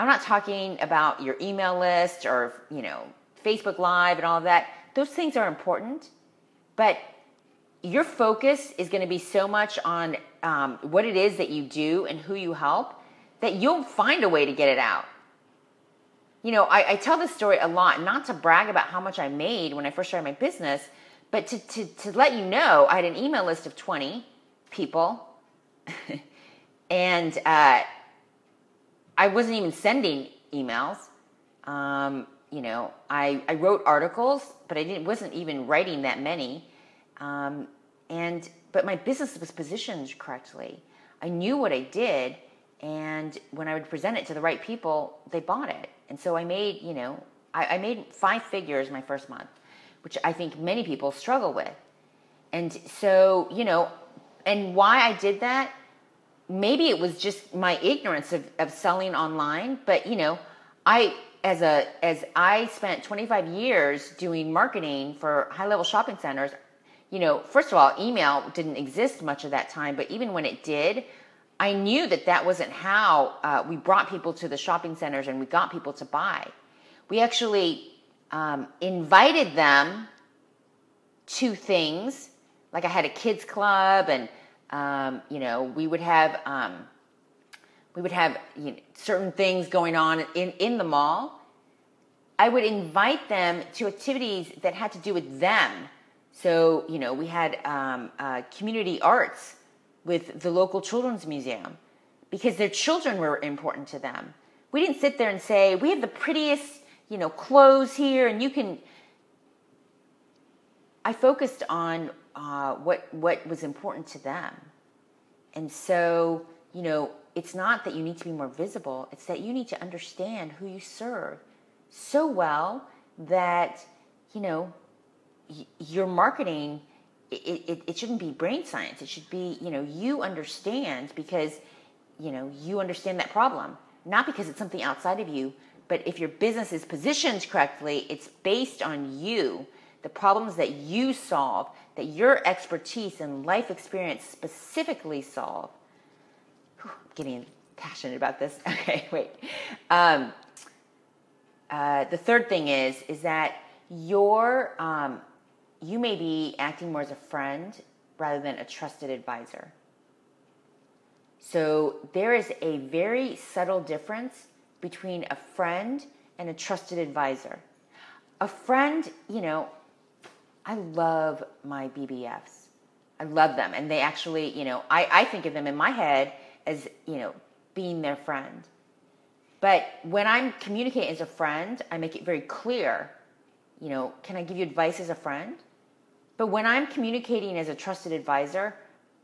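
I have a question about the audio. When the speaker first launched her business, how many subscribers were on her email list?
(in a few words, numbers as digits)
20.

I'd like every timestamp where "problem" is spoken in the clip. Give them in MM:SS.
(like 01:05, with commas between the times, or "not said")
02:13, 02:20.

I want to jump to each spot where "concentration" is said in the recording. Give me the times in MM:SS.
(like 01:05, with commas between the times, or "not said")
not said.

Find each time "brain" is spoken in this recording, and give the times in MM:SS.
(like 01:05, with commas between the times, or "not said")
02:08.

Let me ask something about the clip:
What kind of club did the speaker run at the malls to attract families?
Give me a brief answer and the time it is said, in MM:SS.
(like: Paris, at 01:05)
kids club, at 01:23.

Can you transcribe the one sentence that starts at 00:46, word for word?
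And so I made, you know, I, I made five figures my first month which I think many people struggle with.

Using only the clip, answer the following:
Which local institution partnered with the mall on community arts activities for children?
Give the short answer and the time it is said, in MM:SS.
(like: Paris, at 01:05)
children's museum, at 01:40.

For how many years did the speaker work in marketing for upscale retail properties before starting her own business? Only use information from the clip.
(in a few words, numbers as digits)
25.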